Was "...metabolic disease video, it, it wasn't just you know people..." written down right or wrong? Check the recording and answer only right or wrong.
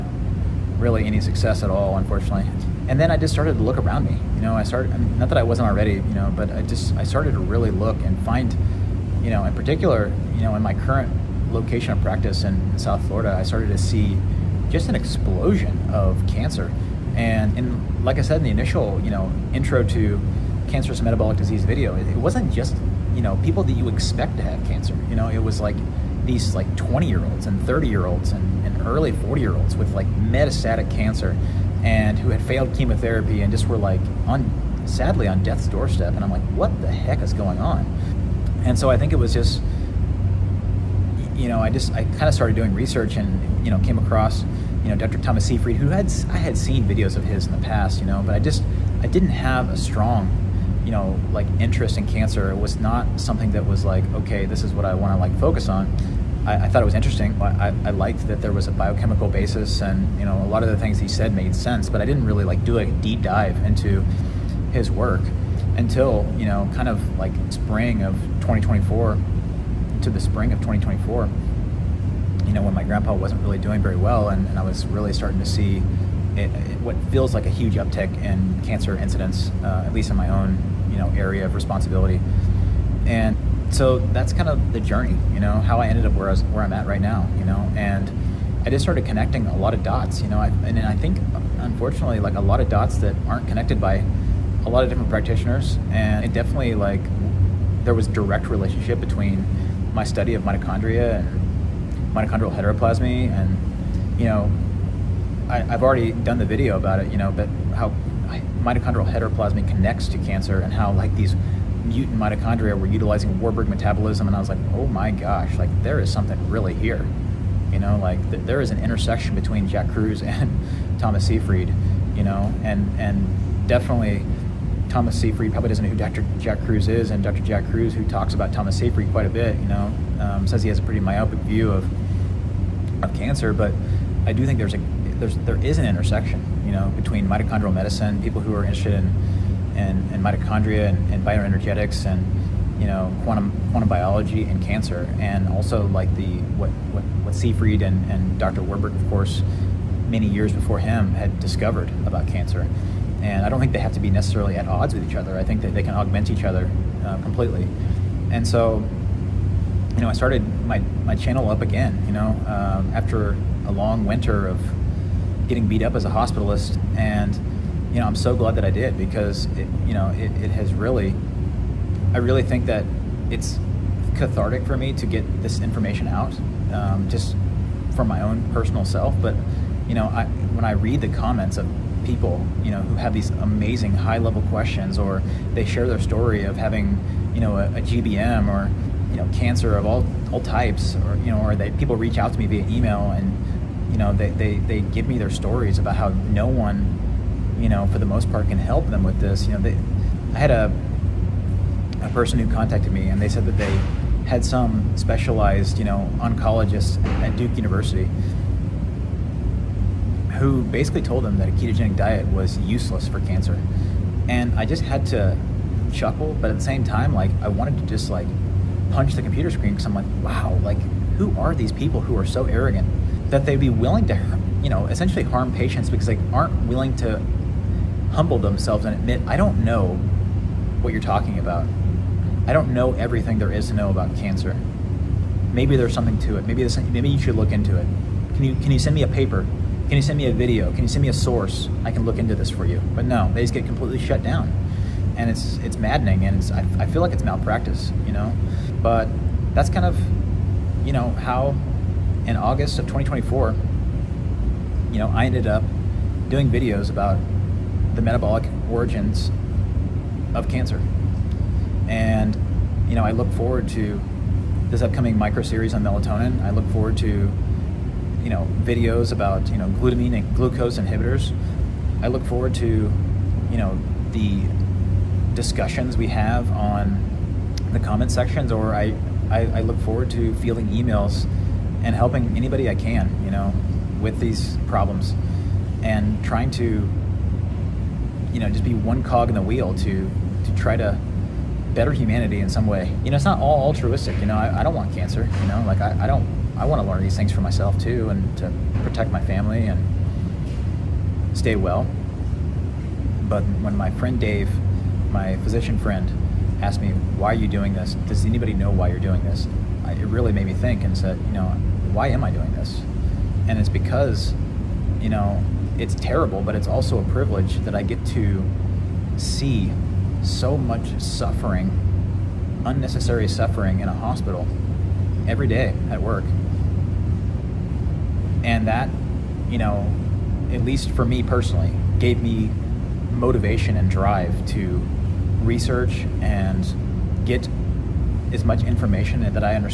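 right.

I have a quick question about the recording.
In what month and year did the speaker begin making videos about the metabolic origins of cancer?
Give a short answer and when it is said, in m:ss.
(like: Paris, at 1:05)
August 2024, at 4:12.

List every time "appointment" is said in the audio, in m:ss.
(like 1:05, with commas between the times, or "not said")
not said.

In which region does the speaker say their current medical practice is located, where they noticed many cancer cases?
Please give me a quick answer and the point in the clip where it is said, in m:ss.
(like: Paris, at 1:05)
South Florida, at 0:12.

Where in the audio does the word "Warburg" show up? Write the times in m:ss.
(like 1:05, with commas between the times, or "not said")
1:53, 2:28.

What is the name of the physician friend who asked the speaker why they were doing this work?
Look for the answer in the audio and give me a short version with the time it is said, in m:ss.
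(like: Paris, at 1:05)
Dave, at 5:04.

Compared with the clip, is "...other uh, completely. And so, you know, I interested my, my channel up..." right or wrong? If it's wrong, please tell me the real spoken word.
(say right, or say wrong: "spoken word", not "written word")
wrong: "started", not "interested".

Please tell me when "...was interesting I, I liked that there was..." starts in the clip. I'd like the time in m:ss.
0:56.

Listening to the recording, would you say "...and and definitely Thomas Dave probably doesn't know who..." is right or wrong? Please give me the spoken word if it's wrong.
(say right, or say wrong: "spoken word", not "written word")
wrong: "Seyfried", not "Dave".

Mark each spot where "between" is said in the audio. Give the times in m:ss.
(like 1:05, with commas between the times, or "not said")
1:38, 1:59, 2:16.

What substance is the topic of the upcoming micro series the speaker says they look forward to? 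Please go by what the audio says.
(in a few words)
melatonin.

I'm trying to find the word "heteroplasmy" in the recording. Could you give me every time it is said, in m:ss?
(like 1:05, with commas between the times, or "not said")
1:42, 1:49.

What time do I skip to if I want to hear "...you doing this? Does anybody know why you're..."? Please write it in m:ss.
5:07.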